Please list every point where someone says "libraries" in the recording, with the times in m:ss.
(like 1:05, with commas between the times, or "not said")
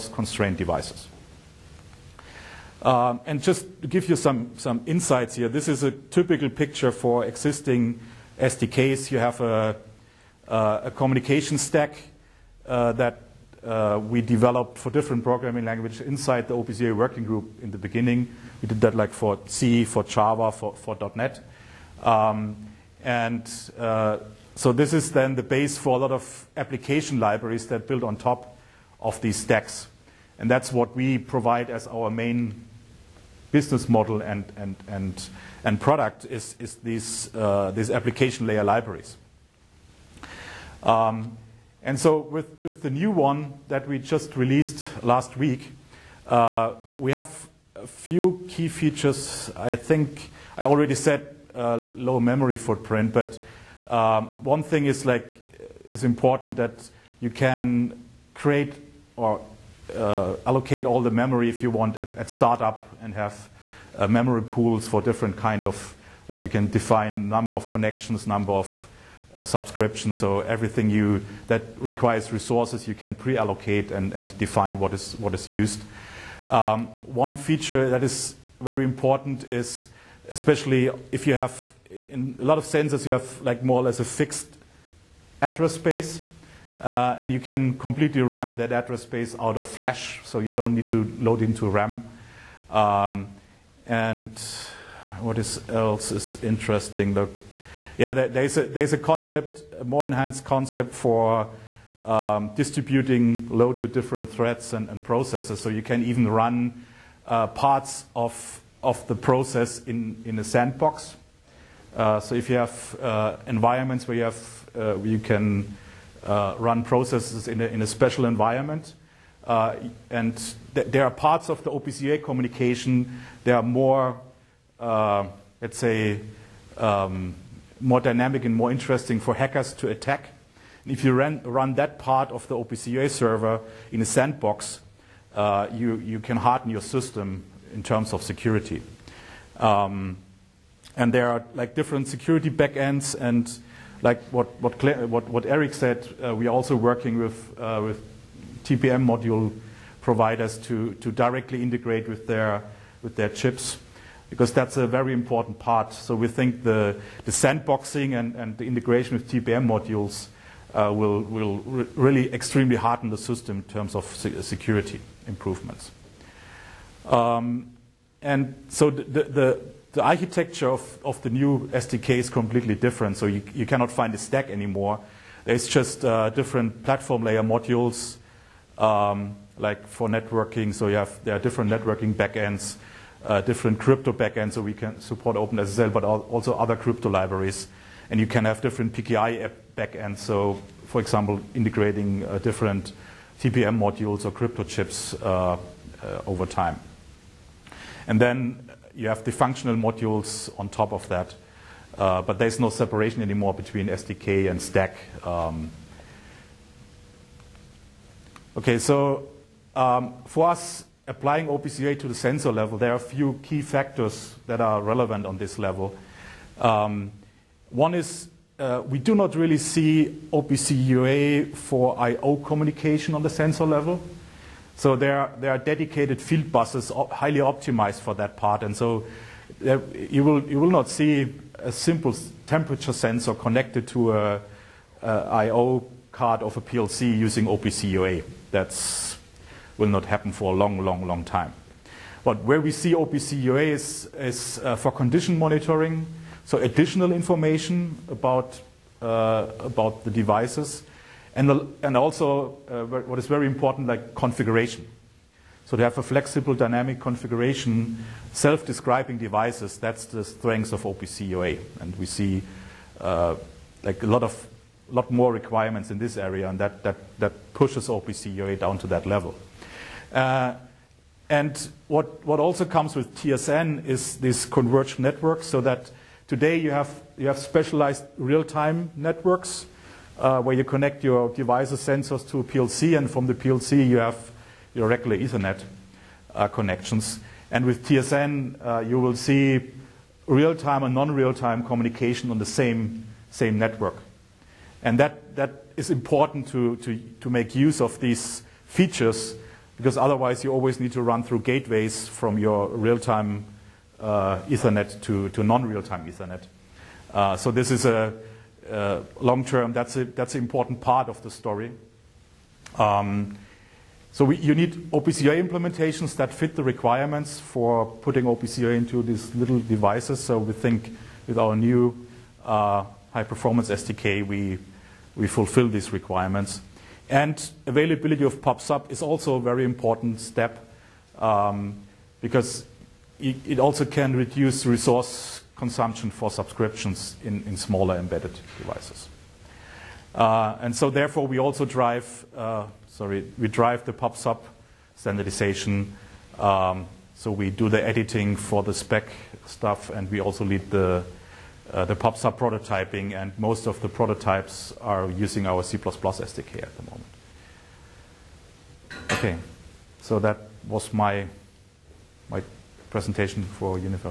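0:27, 0:38, 3:07.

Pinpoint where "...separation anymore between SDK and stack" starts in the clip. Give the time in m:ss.
3:22.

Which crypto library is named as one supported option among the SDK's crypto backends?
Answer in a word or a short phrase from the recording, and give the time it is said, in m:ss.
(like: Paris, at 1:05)
OpenSSL, at 3:05.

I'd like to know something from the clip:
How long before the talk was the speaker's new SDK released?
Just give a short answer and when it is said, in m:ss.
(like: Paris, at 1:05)
Last week, at 0:45.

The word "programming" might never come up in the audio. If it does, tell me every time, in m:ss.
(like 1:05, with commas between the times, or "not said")
0:15.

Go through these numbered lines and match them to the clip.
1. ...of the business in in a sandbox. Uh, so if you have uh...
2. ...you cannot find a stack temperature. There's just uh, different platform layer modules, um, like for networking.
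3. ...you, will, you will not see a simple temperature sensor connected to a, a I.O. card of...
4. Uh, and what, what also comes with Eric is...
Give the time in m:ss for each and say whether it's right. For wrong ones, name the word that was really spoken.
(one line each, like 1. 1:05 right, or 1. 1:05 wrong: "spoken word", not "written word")
1. 1:48 wrong: "process", not "business"
2. 2:53 wrong: "anymore", not "temperature"
3. 3:50 right
4. 4:30 wrong: "TSN", not "Eric".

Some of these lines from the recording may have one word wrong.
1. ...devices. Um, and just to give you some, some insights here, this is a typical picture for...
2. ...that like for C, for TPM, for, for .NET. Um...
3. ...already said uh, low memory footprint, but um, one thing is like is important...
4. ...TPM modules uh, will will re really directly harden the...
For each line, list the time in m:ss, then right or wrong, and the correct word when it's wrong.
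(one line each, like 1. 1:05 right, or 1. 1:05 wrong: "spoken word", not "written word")
1. 0:00 right
2. 0:18 wrong: "Java", not "TPM"
3. 0:50 right
4. 2:39 wrong: "extremely", not "directly".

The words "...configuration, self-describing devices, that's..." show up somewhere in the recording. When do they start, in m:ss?
4:16.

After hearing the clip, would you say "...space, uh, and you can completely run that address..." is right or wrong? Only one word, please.
right.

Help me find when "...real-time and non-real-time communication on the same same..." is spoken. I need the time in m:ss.
4:50.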